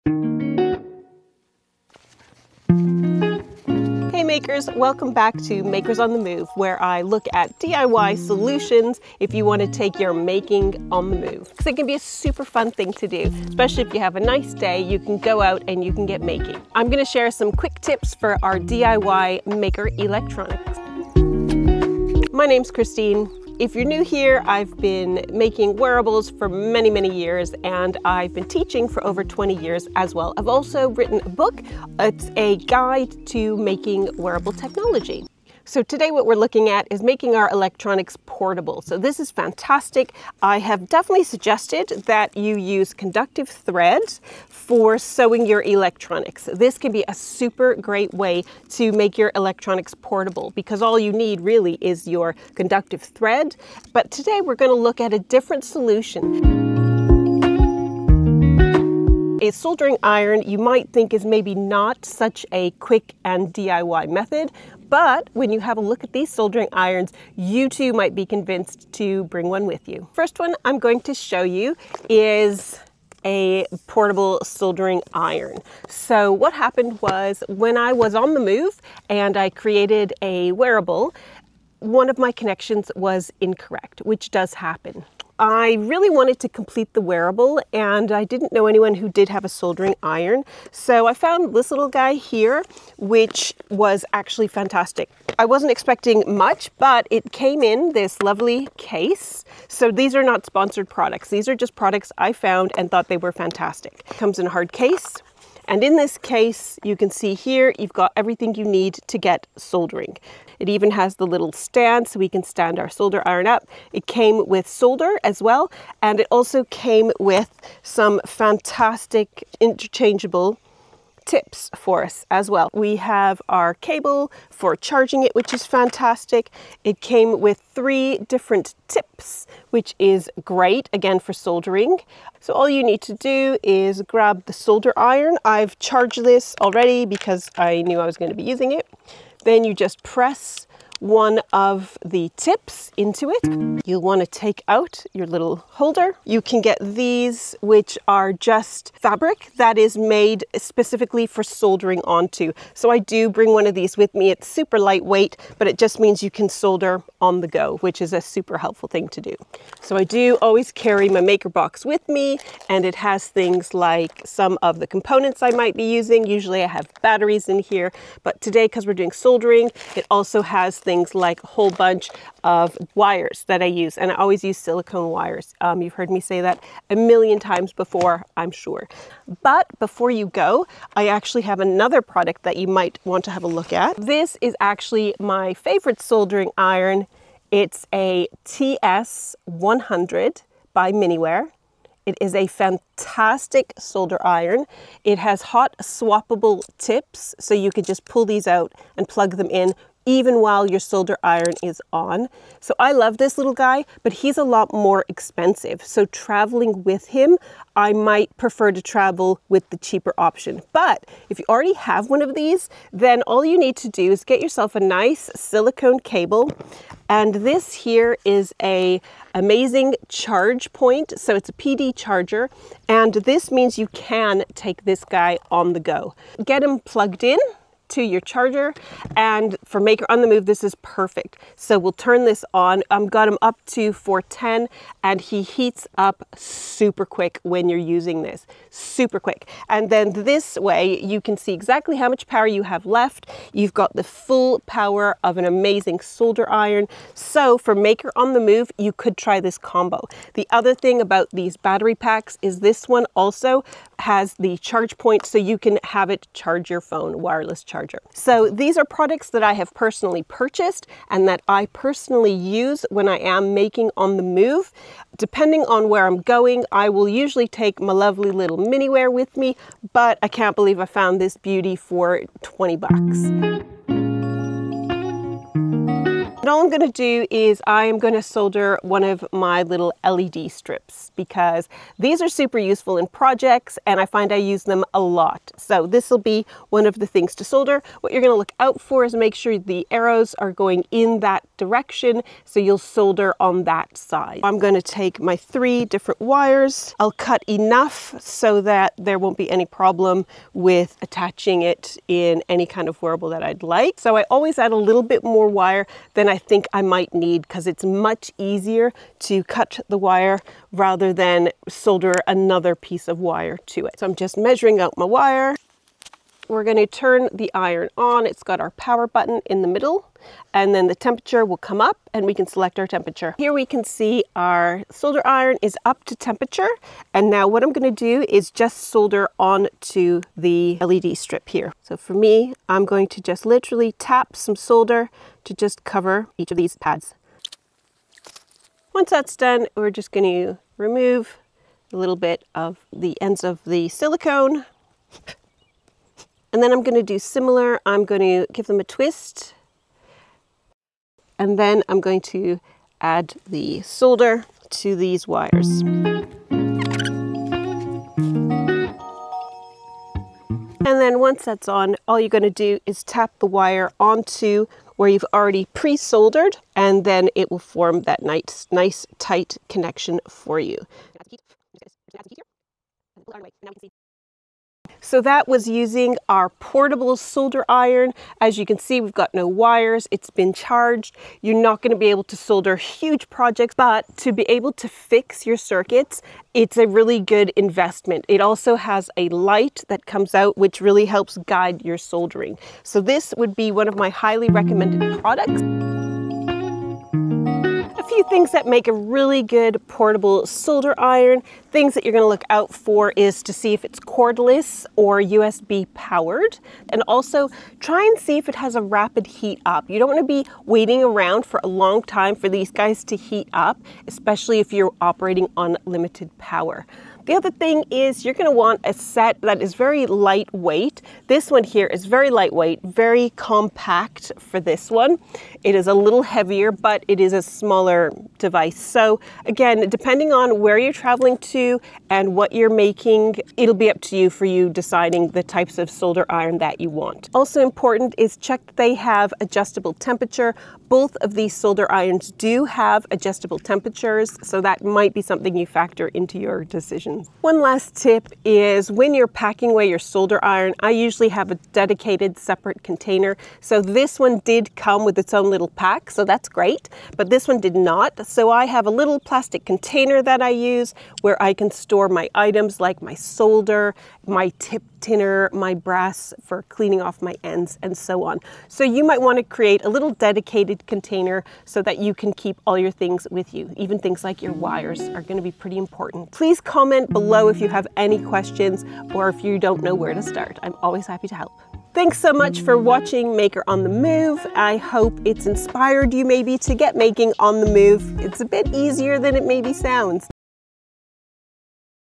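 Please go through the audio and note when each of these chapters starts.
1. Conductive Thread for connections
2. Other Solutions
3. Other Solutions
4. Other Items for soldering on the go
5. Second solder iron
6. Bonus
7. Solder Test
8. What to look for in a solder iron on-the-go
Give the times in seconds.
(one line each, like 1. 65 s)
1. 10 s
2. 58 s
3. 74 s
4. 146 s
5. 180 s
6. 215 s
7. 275 s
8. 395 s.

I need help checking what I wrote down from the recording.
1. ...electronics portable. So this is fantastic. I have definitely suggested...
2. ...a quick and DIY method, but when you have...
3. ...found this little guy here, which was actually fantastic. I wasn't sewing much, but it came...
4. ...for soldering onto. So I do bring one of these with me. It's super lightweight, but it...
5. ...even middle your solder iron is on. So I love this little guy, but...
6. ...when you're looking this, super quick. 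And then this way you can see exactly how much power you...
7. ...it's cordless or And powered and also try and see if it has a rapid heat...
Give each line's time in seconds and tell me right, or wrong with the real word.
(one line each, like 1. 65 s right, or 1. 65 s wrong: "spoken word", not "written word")
1. 37 s right
2. 62 s right
3. 91 s wrong: "expecting", not "sewing"
4. 151 s right
5. 200 s wrong: "while", not "middle"
6. 237 s wrong: "using", not "looking"
7. 403 s wrong: "USB", not "And".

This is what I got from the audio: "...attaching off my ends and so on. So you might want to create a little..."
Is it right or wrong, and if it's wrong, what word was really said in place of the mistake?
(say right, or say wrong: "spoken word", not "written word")
wrong: "cleaning", not "attaching".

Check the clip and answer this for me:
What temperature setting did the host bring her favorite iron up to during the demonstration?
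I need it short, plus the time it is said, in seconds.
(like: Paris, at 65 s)
410, at 233 s.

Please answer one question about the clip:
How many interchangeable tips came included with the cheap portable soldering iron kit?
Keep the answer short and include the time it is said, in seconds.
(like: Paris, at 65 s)
3, at 127 s.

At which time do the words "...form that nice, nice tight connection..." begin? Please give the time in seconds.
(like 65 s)
367 s.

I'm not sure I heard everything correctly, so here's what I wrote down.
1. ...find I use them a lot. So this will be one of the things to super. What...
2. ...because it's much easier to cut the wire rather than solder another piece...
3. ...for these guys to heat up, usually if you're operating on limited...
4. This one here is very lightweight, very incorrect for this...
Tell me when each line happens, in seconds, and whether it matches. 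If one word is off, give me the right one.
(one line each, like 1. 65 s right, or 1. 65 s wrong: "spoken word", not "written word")
1. 284 s wrong: "solder", not "super"
2. 307 s right
3. 412 s wrong: "especially", not "usually"
4. 421 s wrong: "compact", not "incorrect".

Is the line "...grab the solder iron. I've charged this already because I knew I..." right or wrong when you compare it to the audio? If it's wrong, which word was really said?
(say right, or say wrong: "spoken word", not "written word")
right.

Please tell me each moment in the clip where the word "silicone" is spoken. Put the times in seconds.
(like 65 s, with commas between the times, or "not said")
174 s, 215 s, 343 s.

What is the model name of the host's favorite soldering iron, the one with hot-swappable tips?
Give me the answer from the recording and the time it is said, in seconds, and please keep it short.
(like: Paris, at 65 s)
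TS100, at 188 s.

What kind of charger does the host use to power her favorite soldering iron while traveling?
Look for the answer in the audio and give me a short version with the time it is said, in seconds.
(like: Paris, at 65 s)
PD charger, at 221 s.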